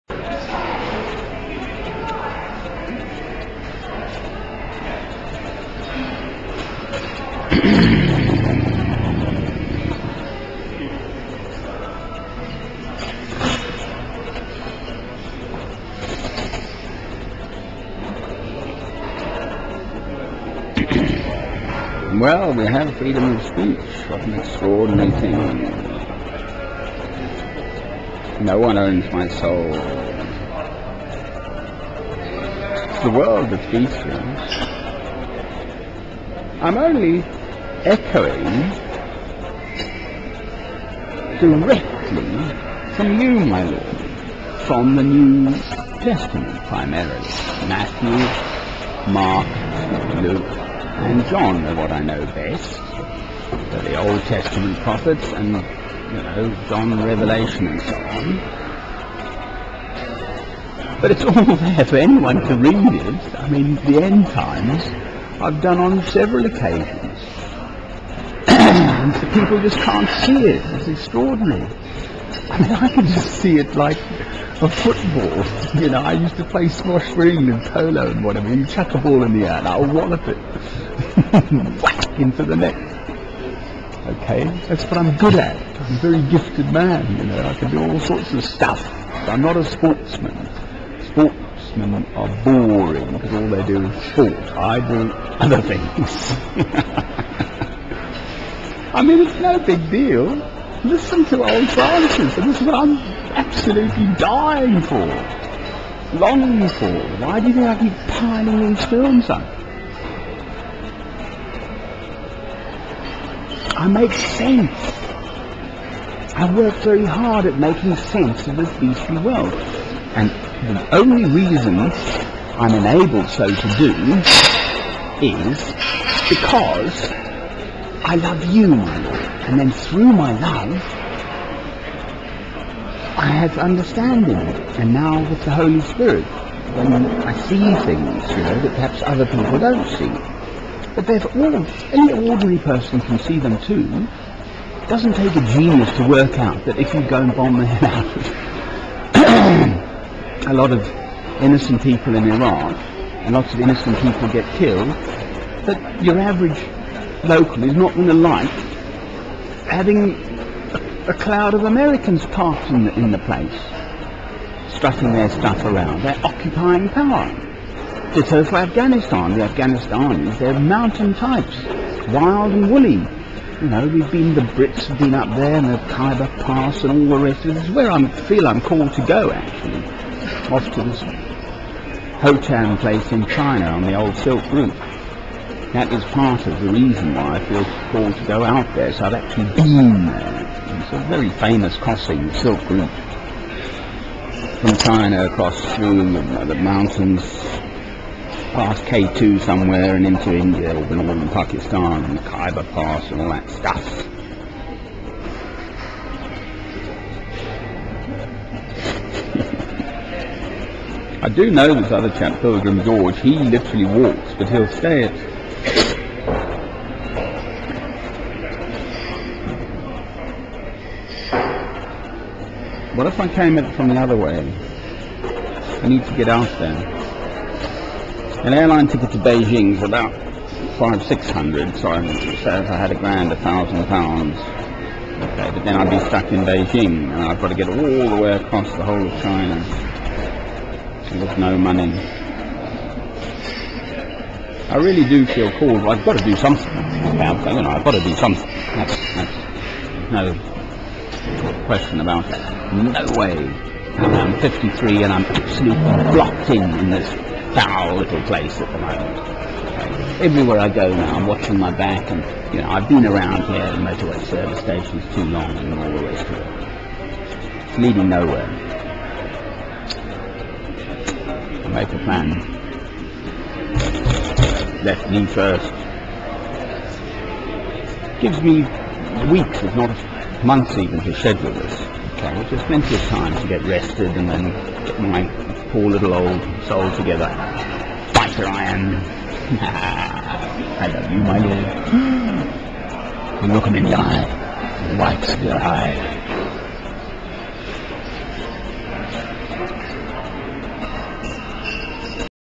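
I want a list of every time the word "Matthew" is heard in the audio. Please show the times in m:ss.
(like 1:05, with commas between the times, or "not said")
0:47.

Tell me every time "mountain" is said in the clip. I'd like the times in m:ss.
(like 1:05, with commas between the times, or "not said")
2:50, 3:16.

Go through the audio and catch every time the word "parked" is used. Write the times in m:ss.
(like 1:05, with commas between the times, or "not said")
2:42.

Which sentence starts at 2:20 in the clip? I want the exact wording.
But they've all, any ordinary person can see them too.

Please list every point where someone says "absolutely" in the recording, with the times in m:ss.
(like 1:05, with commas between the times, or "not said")
1:43, 4:15.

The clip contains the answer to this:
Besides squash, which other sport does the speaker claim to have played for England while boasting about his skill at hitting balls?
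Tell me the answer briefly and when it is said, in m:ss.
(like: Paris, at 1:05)
Polo, at 1:17.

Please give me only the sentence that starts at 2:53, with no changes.
You know, we've been, the Brits have been up there and the Khyber Pass and all the rest of it.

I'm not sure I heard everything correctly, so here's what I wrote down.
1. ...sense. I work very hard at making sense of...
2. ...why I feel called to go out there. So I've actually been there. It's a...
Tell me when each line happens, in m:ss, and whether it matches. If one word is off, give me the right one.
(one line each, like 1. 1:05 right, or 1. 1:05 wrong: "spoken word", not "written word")
1. 1:54 right
2. 3:07 right.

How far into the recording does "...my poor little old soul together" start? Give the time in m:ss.
4:45.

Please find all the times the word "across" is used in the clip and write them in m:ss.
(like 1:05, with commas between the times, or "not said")
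3:15, 3:58.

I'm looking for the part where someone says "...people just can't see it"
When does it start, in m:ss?
1:09.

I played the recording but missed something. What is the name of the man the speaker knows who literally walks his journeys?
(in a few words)
Pilgrim George.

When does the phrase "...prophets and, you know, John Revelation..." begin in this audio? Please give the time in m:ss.
0:54.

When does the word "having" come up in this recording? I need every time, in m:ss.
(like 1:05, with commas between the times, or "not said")
2:39.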